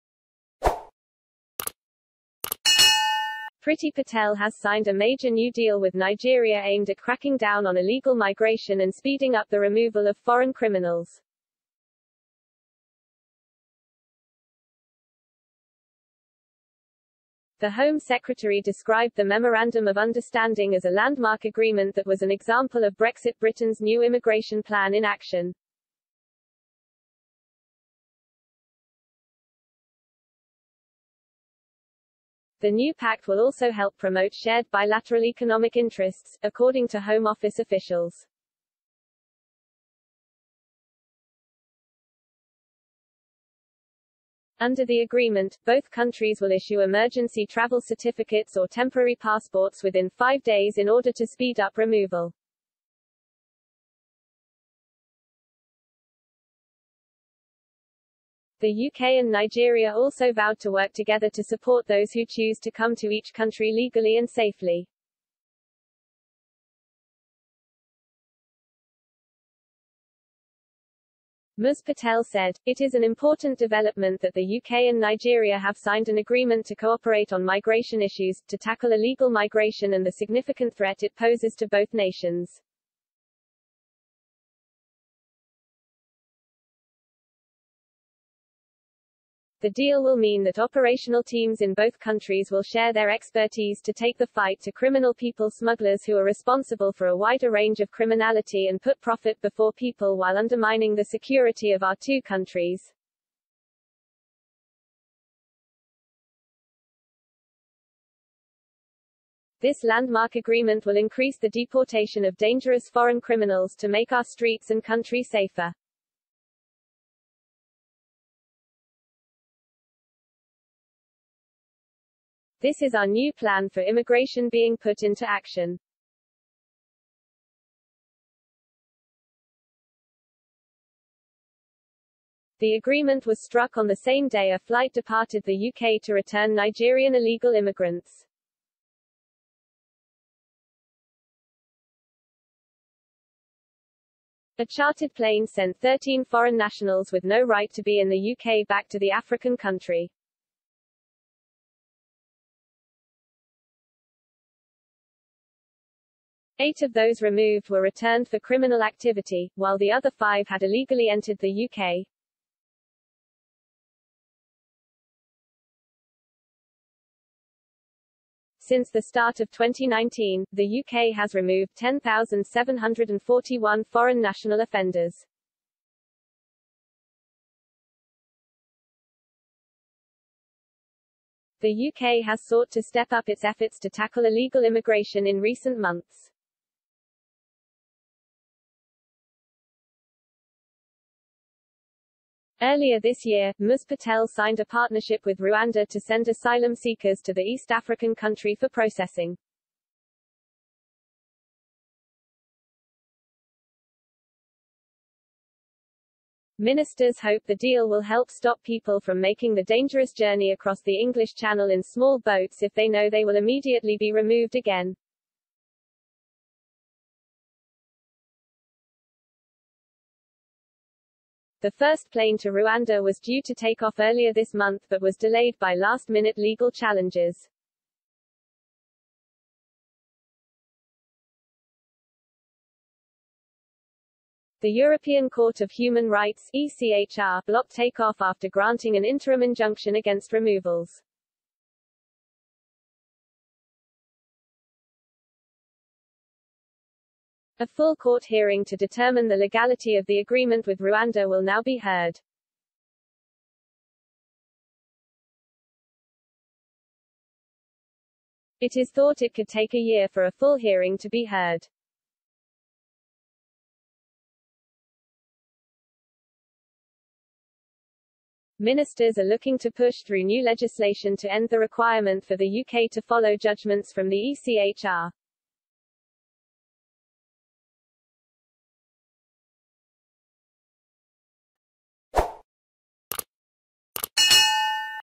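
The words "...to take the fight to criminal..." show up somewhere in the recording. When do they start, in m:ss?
1:33.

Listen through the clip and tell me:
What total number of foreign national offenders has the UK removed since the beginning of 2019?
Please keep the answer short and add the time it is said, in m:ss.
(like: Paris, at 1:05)
10,741, at 2:51.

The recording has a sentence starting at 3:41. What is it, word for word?
The first plane to Rwanda was due to take off earlier this month but was delayed by last-minute legal challenges.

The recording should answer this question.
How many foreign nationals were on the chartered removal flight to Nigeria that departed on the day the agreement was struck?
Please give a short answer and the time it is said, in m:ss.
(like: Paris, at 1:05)
13, at 2:25.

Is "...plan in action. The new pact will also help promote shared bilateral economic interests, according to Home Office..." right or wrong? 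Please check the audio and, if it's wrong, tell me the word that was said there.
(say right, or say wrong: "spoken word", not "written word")
right.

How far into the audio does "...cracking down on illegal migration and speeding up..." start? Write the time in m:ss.
0:06.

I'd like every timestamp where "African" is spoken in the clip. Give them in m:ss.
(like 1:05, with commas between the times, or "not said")
2:29, 3:17.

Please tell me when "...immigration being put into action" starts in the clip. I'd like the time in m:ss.
2:03.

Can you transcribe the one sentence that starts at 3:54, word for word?
The European Court of Human Rights ECHR blocked takeoff after granting an interim injunction against removals.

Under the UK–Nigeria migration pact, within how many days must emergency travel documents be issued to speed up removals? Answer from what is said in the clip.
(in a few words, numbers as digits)
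5 days.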